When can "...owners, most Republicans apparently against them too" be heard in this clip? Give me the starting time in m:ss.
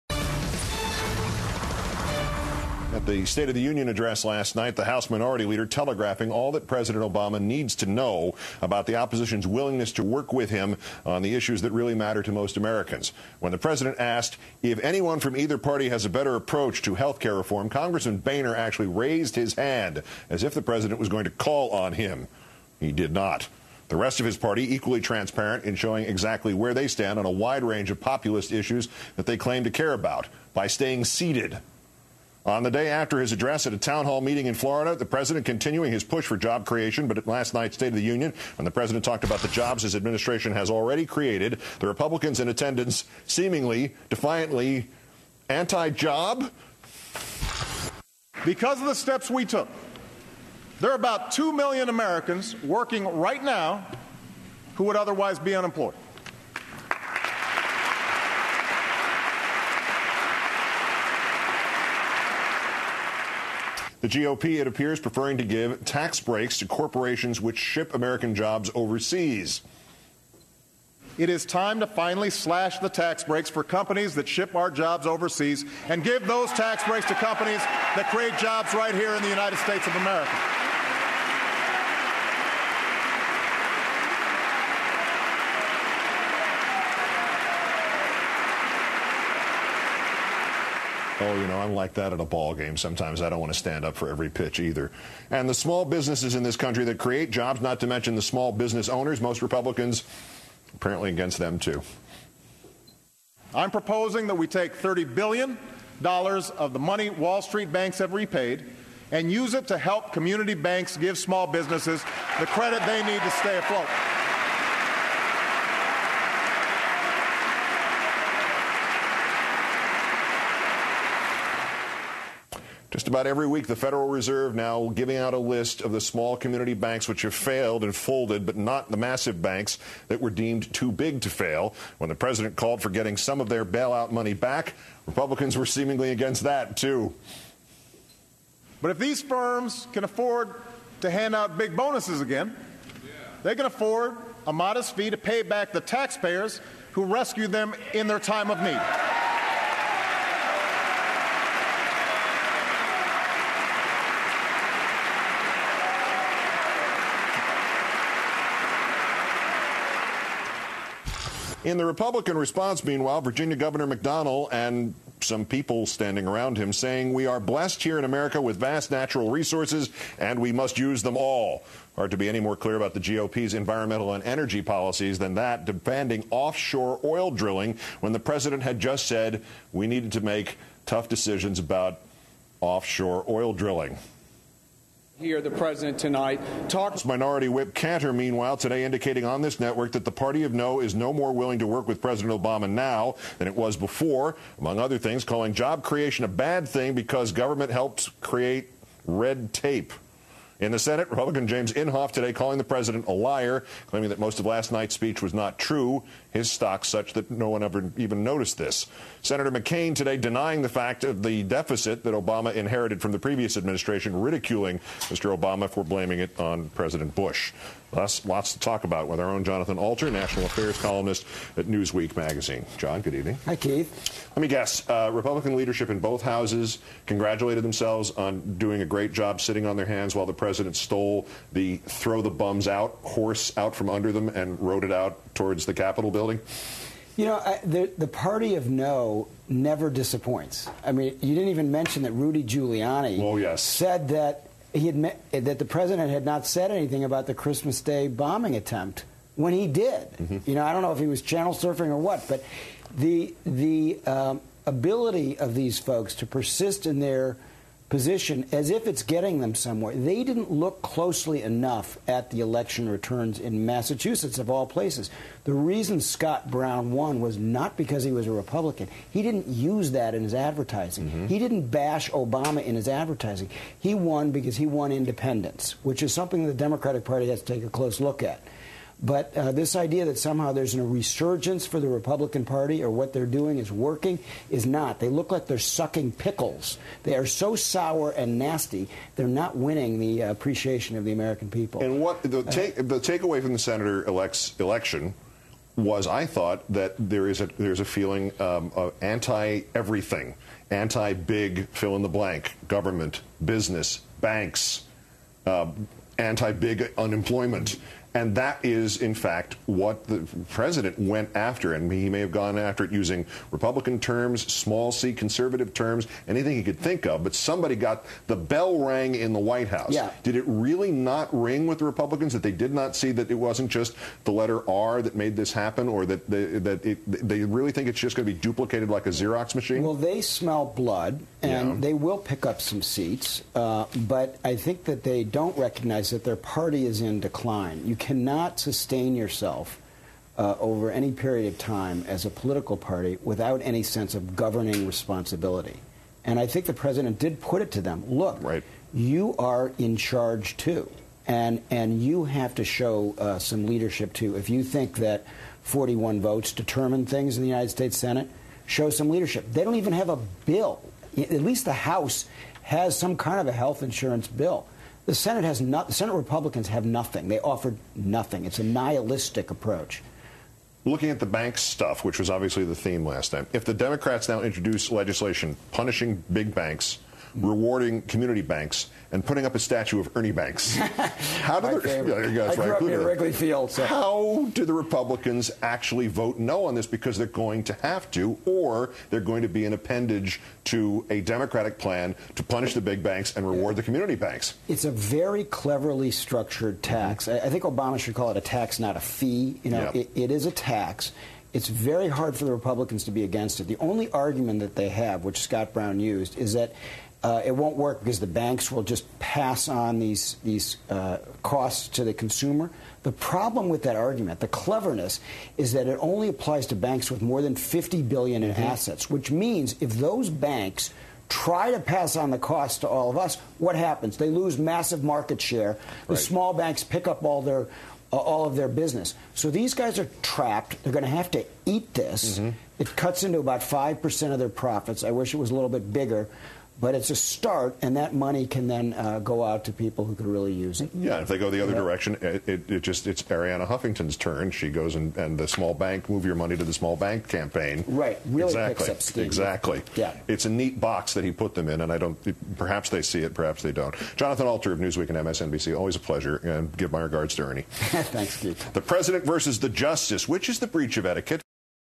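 1:38.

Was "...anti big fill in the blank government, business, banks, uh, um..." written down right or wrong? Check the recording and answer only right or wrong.
right.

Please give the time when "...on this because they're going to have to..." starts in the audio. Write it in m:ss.
6:26.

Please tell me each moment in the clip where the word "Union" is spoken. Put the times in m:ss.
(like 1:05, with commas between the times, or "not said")
0:03, 0:38.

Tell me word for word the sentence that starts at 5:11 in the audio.
And he may have gone after it using Republican terms, small c conservative terms, anything he could think of.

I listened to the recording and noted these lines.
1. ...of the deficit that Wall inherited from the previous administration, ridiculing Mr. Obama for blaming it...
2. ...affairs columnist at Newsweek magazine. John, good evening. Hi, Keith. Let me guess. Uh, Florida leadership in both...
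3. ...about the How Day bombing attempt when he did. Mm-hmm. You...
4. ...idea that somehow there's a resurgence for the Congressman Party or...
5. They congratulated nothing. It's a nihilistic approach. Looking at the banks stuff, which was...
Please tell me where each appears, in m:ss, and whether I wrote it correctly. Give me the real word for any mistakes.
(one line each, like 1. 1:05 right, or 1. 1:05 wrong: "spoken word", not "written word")
1. 3:31 wrong: "Obama", not "Wall"
2. 3:40 wrong: "Republican", not "Florida"
3. 4:07 wrong: "Christmas", not "How"
4. 4:39 wrong: "Republican", not "Congressman"
5. 6:07 wrong: "offered", not "congratulated".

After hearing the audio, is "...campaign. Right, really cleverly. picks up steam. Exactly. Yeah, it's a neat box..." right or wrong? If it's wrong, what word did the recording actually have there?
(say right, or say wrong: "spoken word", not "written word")
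wrong: "exactly", not "cleverly".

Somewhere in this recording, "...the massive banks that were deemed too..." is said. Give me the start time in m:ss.
2:08.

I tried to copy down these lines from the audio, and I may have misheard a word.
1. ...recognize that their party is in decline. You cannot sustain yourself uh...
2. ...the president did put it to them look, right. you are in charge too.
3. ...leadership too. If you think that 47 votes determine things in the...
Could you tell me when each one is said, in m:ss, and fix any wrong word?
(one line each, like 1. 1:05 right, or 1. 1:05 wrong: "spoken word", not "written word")
1. 5:35 right
2. 5:46 right
3. 5:53 wrong: "41", not "47".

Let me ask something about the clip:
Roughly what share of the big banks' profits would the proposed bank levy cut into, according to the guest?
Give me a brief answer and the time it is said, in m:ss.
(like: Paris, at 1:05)
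5%, at 7:13.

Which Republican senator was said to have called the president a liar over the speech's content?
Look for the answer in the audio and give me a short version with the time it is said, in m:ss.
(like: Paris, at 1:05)
James Inhofe, at 3:21.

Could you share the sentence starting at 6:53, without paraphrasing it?
The problem with that argument, the cleverness, is that it only applies to banks with more than 50 billion in mm-hmm.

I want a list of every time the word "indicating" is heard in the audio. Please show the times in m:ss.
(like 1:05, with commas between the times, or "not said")
3:08.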